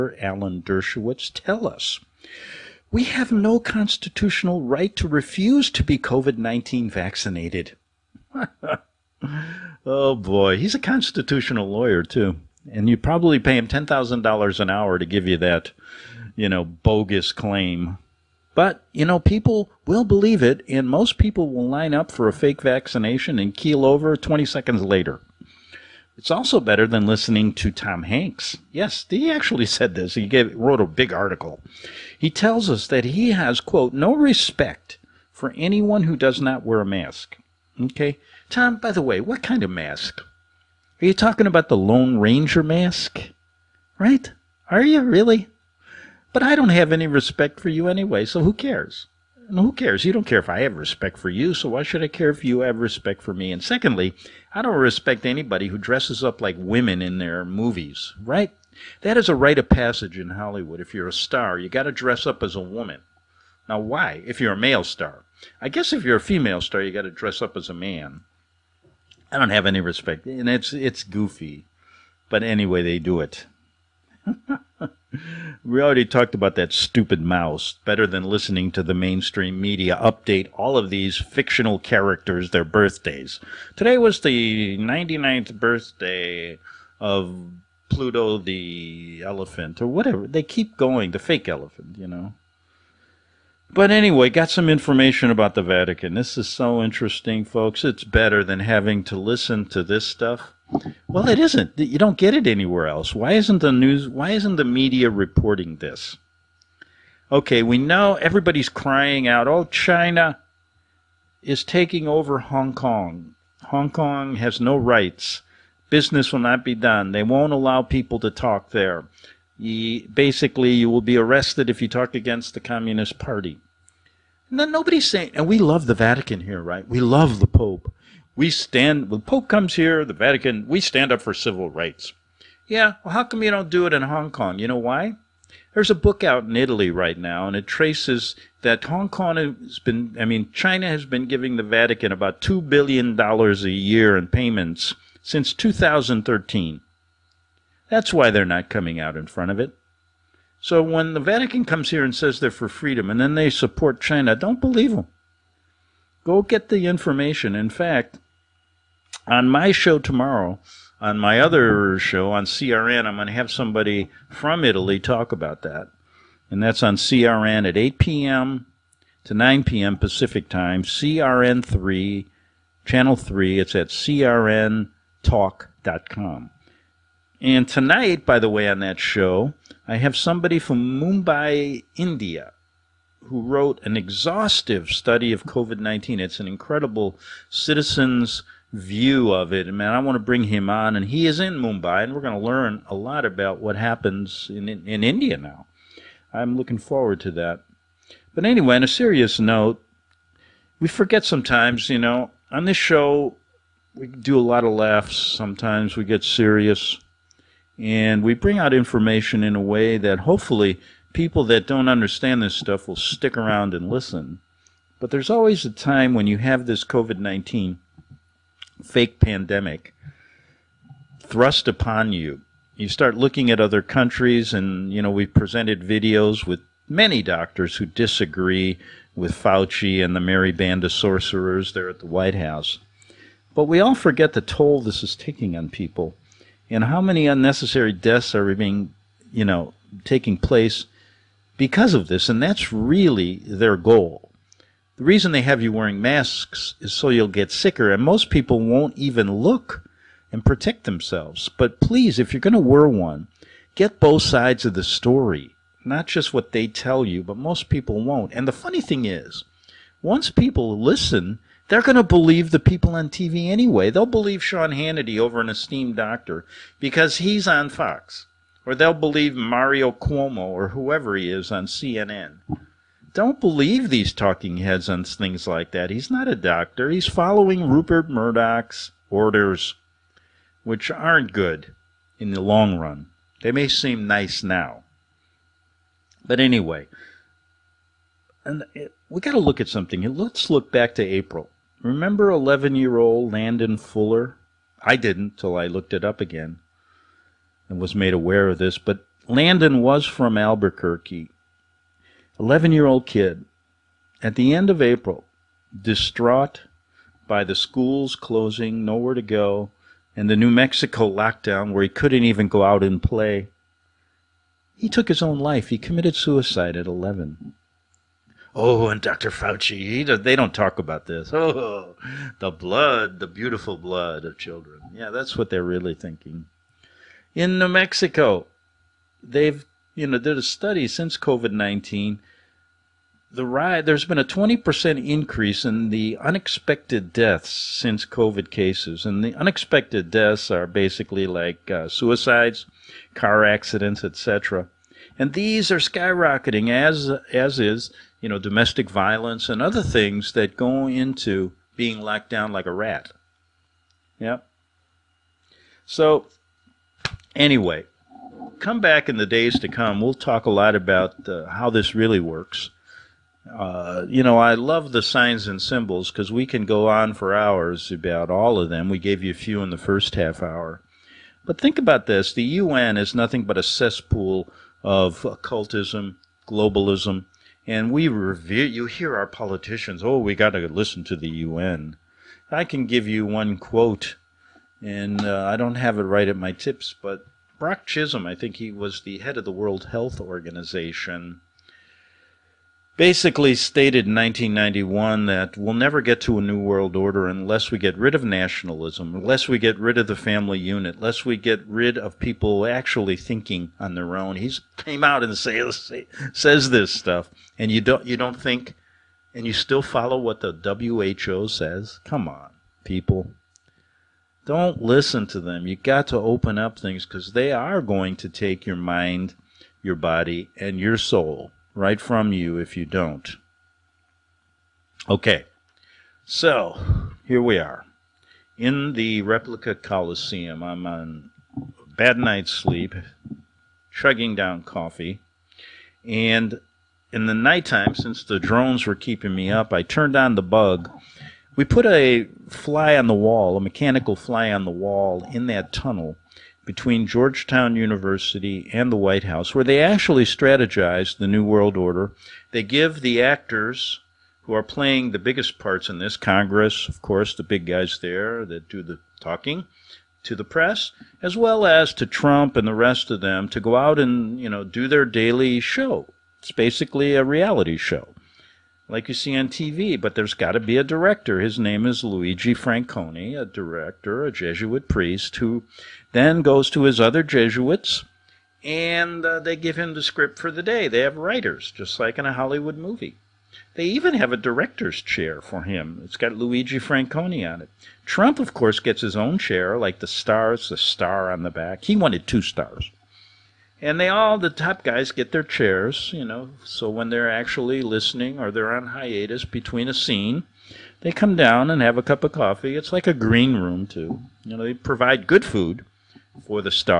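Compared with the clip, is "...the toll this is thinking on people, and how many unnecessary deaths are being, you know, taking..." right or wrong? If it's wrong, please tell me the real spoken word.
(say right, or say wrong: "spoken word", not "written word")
wrong: "taking", not "thinking".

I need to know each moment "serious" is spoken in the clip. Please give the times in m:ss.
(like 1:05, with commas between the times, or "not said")
3:18, 3:26.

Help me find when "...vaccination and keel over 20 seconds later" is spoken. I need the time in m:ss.
0:22.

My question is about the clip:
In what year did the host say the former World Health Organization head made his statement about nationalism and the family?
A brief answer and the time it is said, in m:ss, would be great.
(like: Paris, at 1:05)
1991, at 6:34.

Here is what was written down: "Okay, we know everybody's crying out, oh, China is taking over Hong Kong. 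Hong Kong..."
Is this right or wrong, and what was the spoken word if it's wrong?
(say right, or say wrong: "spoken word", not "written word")
right.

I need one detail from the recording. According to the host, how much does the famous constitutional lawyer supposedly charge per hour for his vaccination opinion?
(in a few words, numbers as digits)
$10,000.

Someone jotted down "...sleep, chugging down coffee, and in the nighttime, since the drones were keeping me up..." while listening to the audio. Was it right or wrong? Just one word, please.
right.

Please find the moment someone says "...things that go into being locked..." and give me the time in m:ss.
5:49.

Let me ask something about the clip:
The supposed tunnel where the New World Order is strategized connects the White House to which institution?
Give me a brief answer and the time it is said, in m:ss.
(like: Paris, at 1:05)
Georgetown University, at 7:27.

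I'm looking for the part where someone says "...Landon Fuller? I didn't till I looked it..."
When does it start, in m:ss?
4:53.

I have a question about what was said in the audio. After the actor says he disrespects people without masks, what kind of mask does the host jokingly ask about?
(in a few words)
Lone Ranger mask.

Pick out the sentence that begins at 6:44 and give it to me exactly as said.
He came out and says says this stuff, and you don't you don't think, and you still follow what the WHO says.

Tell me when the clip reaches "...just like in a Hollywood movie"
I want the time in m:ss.
8:01.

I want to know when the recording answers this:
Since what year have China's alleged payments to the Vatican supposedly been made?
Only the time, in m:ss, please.
2:25.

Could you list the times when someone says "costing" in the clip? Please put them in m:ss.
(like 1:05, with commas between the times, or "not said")
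not said.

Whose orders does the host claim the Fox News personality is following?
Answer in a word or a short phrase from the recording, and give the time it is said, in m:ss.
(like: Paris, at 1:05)
Rupert Murdoch, at 4:37.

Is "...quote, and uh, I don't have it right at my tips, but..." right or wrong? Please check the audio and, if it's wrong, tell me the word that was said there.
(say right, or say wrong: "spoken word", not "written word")
right.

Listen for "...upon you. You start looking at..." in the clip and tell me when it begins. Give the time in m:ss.
3:41.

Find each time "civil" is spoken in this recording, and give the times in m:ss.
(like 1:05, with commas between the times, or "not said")
2:11.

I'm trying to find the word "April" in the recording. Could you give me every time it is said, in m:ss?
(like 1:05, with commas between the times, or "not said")
4:51, 5:04.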